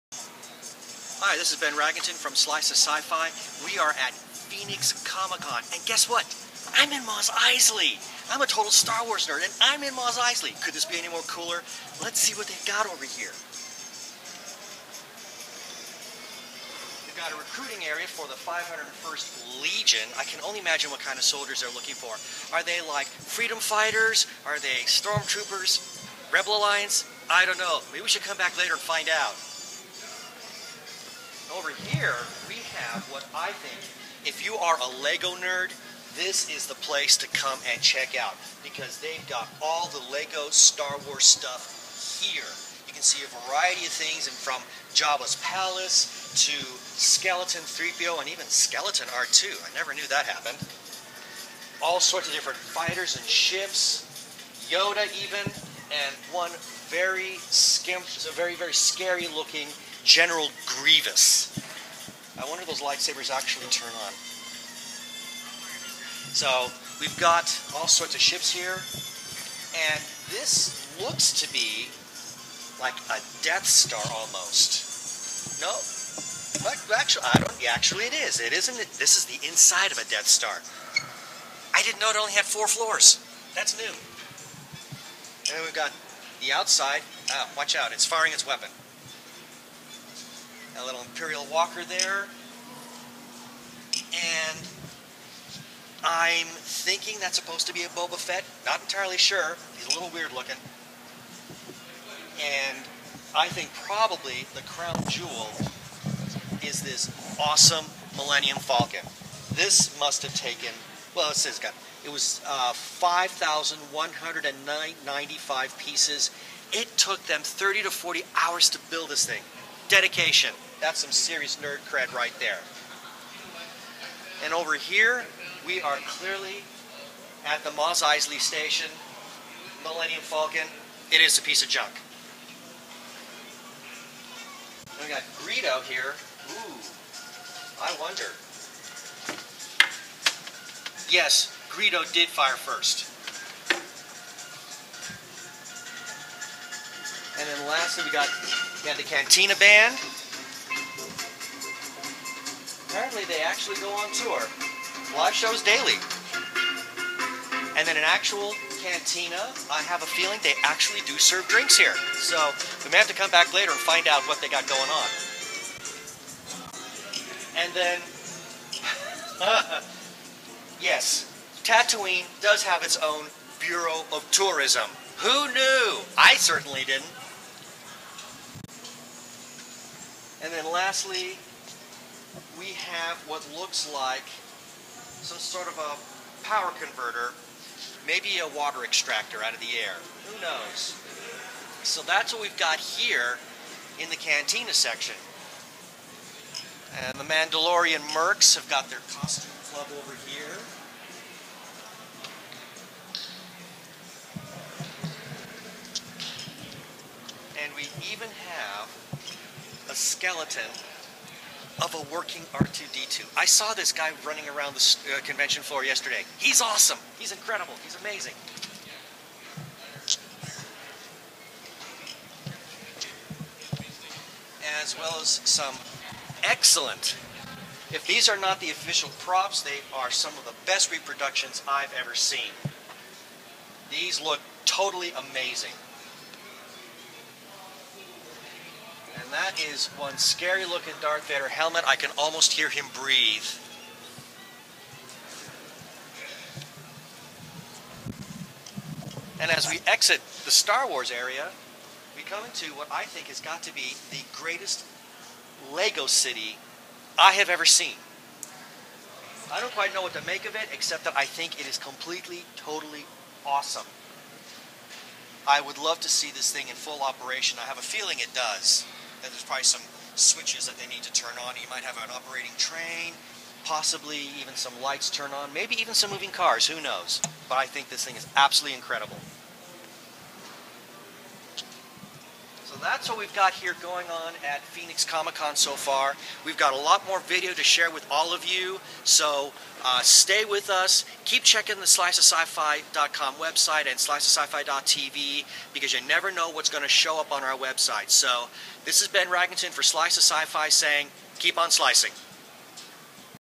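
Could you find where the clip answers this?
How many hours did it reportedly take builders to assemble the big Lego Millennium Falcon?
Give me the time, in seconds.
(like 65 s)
117 s.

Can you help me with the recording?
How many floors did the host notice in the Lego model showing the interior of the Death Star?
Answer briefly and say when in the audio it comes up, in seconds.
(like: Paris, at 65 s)
4, at 82 s.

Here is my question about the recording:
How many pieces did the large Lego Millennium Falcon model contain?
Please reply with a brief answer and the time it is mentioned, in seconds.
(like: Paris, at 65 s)
5,195, at 112 s.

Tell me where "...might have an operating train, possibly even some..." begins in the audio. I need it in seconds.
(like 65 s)
271 s.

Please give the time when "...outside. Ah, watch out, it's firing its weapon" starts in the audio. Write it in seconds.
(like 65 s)
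86 s.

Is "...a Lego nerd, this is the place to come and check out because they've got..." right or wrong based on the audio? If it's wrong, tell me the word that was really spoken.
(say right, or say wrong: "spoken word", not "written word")
right.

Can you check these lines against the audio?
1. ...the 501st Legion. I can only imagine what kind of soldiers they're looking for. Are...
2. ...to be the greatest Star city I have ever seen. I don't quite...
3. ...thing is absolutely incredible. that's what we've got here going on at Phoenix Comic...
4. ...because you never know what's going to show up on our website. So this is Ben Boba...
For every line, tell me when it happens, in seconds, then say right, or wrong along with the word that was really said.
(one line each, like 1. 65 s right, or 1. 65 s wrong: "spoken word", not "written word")
1. 18 s right
2. 253 s wrong: "Lego", not "Star"
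3. 278 s right
4. 295 s wrong: "Ragunton", not "Boba".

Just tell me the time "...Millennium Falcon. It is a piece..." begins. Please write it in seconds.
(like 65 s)
129 s.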